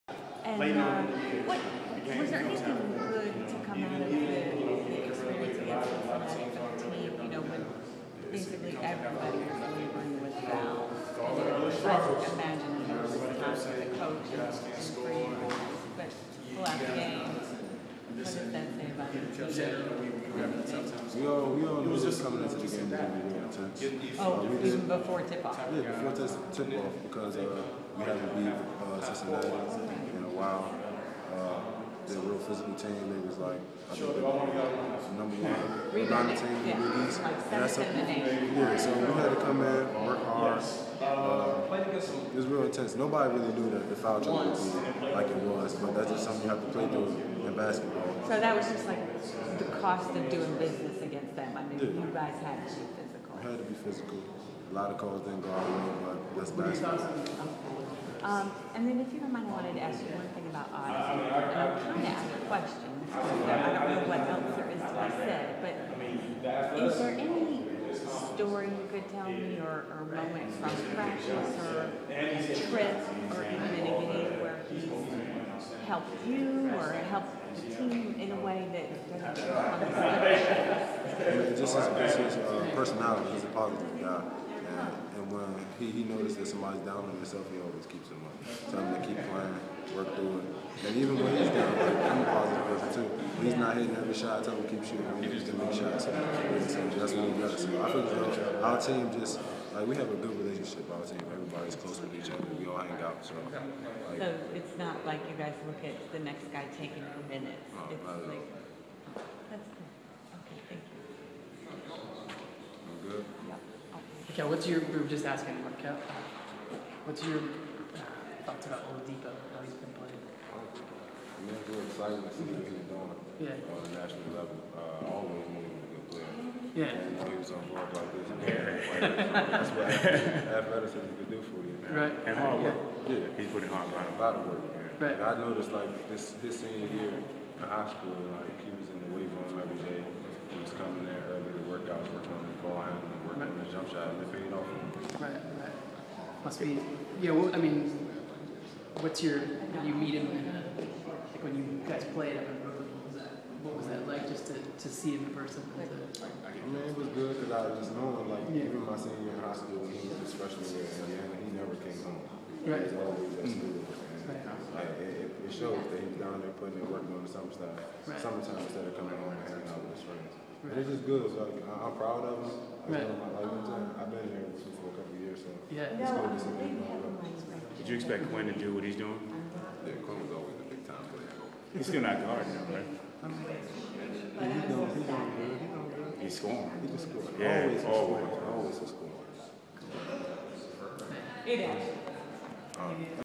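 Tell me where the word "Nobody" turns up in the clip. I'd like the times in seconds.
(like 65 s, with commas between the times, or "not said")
42 s.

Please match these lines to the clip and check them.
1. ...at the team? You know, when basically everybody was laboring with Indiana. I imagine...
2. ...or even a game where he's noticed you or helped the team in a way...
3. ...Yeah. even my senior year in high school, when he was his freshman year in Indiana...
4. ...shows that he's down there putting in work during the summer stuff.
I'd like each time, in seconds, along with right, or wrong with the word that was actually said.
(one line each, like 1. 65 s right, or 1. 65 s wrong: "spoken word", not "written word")
1. 5 s wrong: "Val", not "Indiana"
2. 73 s wrong: "helped", not "noticed"
3. 158 s right
4. 165 s right.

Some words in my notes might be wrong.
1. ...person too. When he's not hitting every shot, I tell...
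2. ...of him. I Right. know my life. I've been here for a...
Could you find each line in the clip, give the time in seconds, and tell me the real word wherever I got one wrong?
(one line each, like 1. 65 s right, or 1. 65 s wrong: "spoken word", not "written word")
1. 92 s right
2. 172 s right.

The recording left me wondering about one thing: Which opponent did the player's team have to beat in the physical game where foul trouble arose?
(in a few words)
Cincinnati.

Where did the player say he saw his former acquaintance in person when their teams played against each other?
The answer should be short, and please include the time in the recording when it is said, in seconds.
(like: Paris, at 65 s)
Brooklyn, at 152 s.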